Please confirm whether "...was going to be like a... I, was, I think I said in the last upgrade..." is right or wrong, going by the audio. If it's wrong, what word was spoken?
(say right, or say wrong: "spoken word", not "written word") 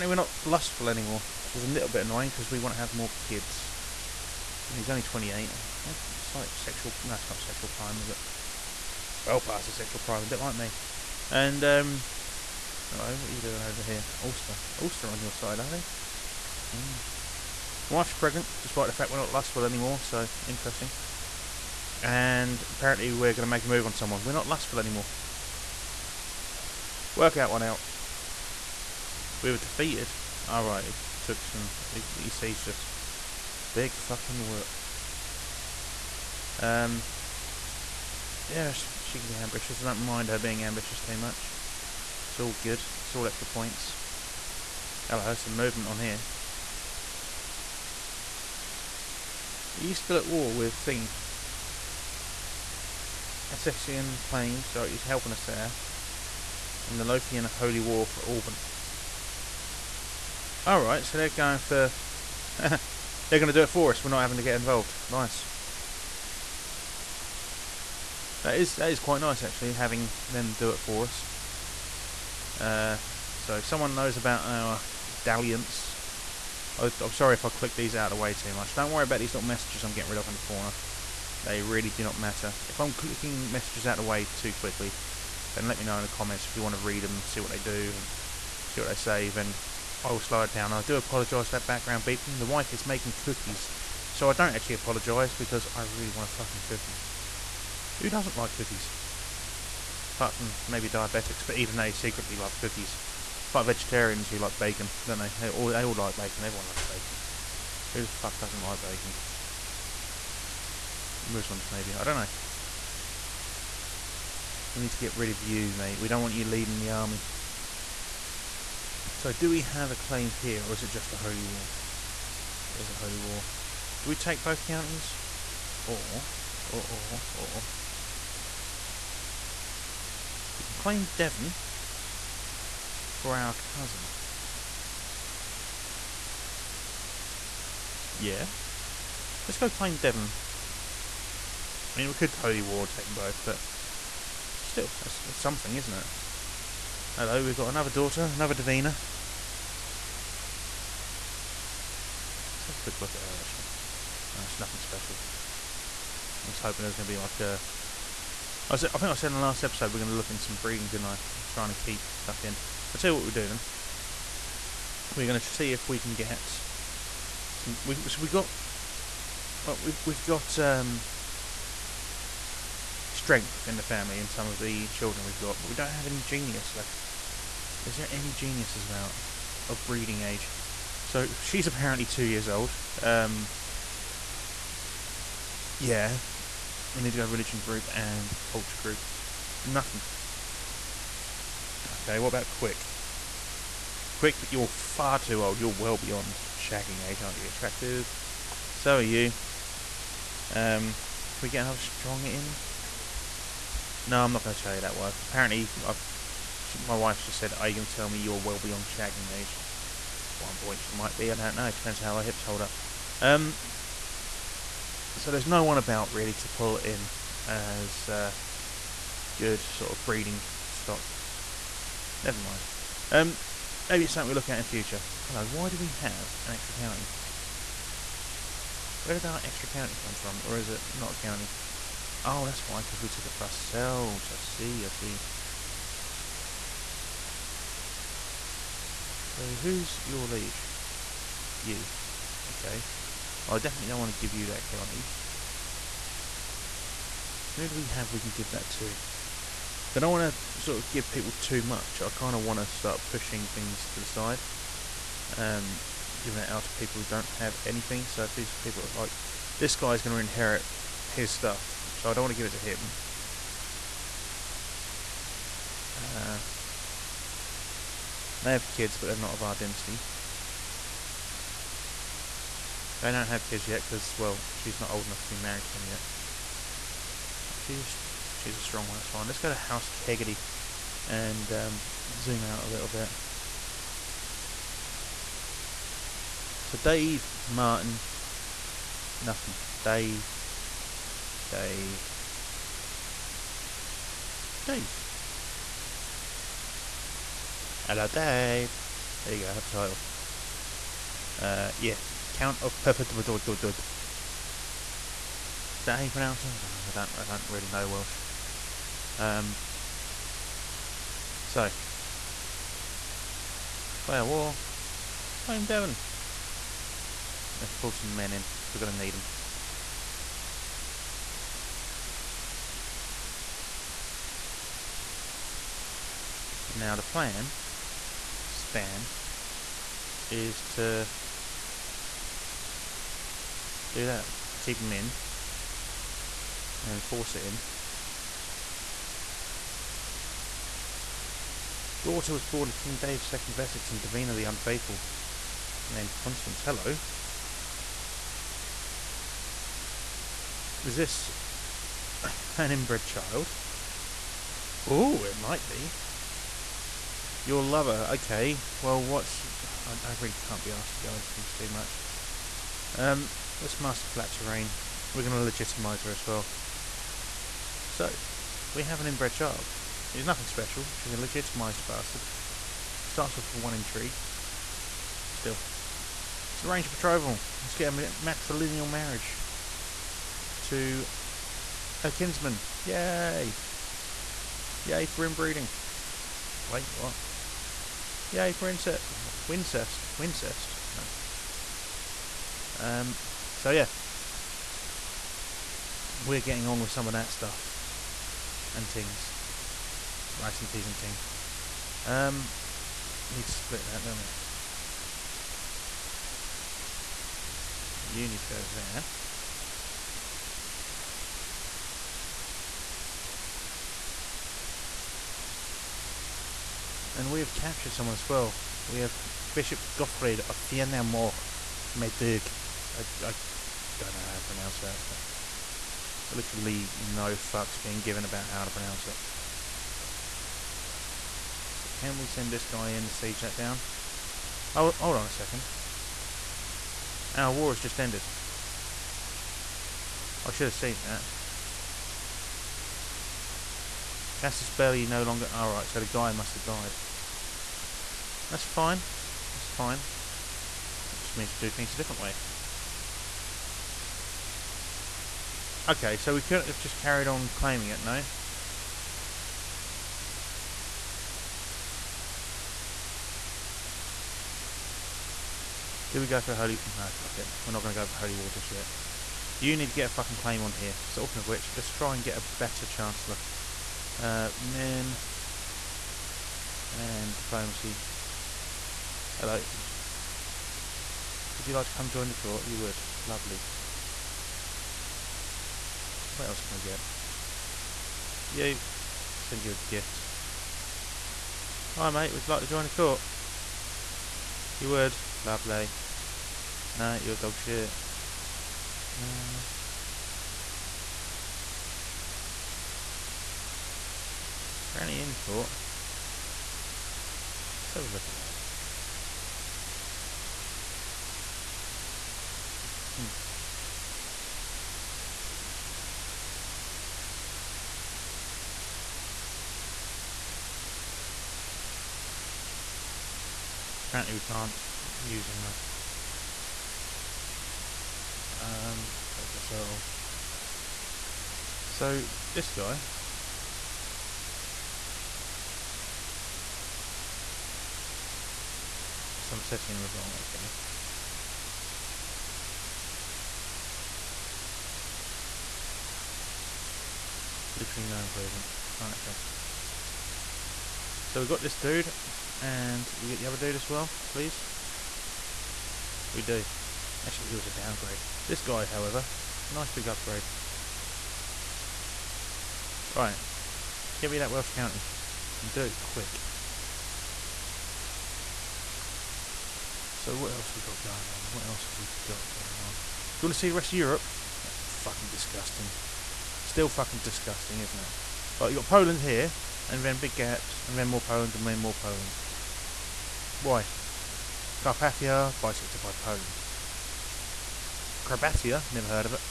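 wrong: "episode", not "upgrade".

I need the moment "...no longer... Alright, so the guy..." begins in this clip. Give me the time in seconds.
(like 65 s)
445 s.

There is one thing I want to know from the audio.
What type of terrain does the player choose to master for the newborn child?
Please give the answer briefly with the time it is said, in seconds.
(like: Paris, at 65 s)
flat terrain, at 364 s.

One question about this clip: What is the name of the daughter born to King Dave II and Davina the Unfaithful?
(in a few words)
Constance.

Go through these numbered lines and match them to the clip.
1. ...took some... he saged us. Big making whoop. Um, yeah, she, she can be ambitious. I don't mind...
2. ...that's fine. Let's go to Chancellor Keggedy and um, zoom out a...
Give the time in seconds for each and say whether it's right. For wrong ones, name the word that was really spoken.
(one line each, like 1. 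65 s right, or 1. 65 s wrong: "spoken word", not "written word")
1. 31 s wrong: "fucking", not "making"
2. 278 s wrong: "House", not "Chancellor".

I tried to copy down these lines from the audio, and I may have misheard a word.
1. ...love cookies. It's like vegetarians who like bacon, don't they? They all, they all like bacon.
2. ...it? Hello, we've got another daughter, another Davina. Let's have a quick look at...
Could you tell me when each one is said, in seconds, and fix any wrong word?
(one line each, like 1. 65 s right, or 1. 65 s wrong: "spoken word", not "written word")
1. 102 s right
2. 145 s right.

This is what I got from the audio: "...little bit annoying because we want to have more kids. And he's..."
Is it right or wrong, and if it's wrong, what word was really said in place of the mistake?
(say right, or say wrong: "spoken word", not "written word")
right.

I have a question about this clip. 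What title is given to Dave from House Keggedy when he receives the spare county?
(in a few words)
Count of Perfect.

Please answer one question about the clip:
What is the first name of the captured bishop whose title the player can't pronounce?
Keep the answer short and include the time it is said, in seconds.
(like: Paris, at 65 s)
Gottfried, at 419 s.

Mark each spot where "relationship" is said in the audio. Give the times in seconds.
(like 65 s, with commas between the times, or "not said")
not said.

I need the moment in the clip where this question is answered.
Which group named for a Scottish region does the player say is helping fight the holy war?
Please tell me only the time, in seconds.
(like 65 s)
57 s.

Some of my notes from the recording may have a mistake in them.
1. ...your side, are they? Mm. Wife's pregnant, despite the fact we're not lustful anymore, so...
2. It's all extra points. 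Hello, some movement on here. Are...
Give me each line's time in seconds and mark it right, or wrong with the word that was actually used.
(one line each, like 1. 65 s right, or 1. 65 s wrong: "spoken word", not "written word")
1. 15 s right
2. 43 s right.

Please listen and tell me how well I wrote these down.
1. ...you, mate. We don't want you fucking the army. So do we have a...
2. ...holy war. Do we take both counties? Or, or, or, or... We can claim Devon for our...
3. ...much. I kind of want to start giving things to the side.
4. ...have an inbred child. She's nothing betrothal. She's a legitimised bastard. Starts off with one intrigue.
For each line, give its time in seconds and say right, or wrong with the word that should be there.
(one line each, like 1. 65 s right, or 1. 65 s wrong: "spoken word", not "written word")
1. 115 s wrong: "leading", not "fucking"
2. 122 s right
3. 251 s wrong: "pushing", not "giving"
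4. 368 s wrong: "special", not "betrothal".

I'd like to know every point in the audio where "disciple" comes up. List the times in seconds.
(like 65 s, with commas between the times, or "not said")
not said.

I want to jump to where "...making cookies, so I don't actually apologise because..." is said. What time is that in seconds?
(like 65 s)
92 s.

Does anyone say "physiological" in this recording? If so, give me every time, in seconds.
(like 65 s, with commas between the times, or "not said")
not said.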